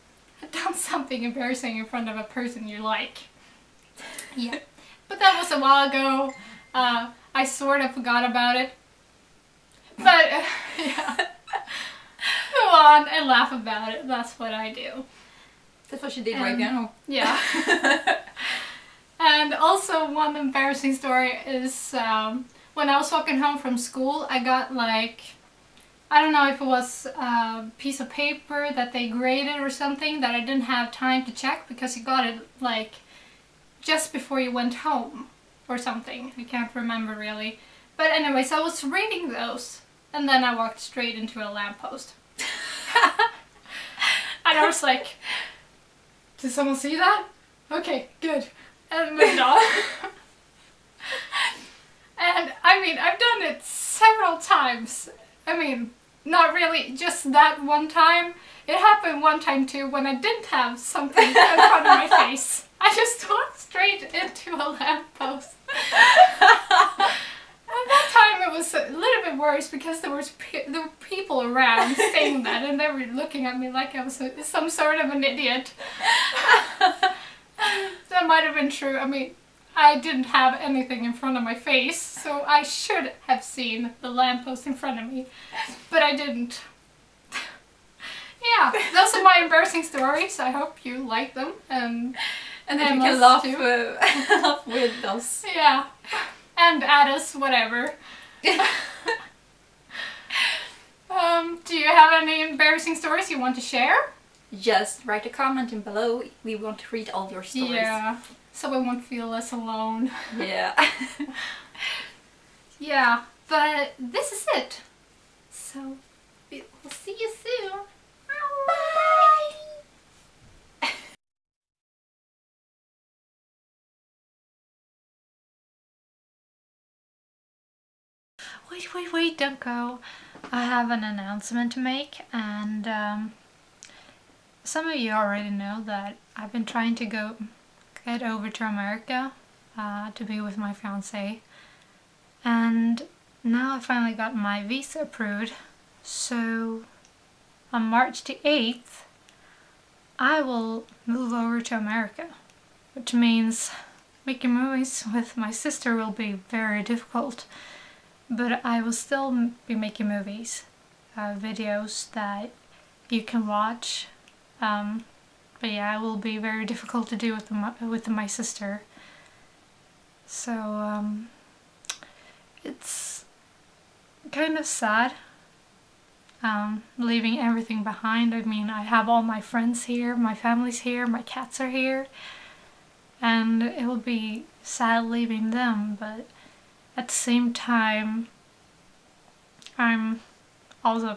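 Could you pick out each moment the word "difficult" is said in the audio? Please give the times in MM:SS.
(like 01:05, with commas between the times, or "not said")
02:36, 02:46.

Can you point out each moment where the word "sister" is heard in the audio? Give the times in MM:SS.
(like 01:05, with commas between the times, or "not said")
02:35, 02:48.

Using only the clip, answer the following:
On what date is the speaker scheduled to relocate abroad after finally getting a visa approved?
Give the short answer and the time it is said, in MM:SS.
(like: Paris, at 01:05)
March 8, at 02:27.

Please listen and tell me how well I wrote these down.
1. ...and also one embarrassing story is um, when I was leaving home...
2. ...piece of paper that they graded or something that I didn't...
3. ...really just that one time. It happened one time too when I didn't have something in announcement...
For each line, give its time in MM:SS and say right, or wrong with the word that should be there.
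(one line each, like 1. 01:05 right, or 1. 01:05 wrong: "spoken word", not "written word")
1. 00:19 wrong: "walking", not "leaving"
2. 00:27 right
3. 00:56 wrong: "front", not "announcement".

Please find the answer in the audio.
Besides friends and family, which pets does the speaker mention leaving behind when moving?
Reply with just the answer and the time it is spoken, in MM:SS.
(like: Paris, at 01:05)
cats, at 03:01.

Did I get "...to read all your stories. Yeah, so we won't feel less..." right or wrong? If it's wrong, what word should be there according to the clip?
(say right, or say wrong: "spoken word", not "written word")
right.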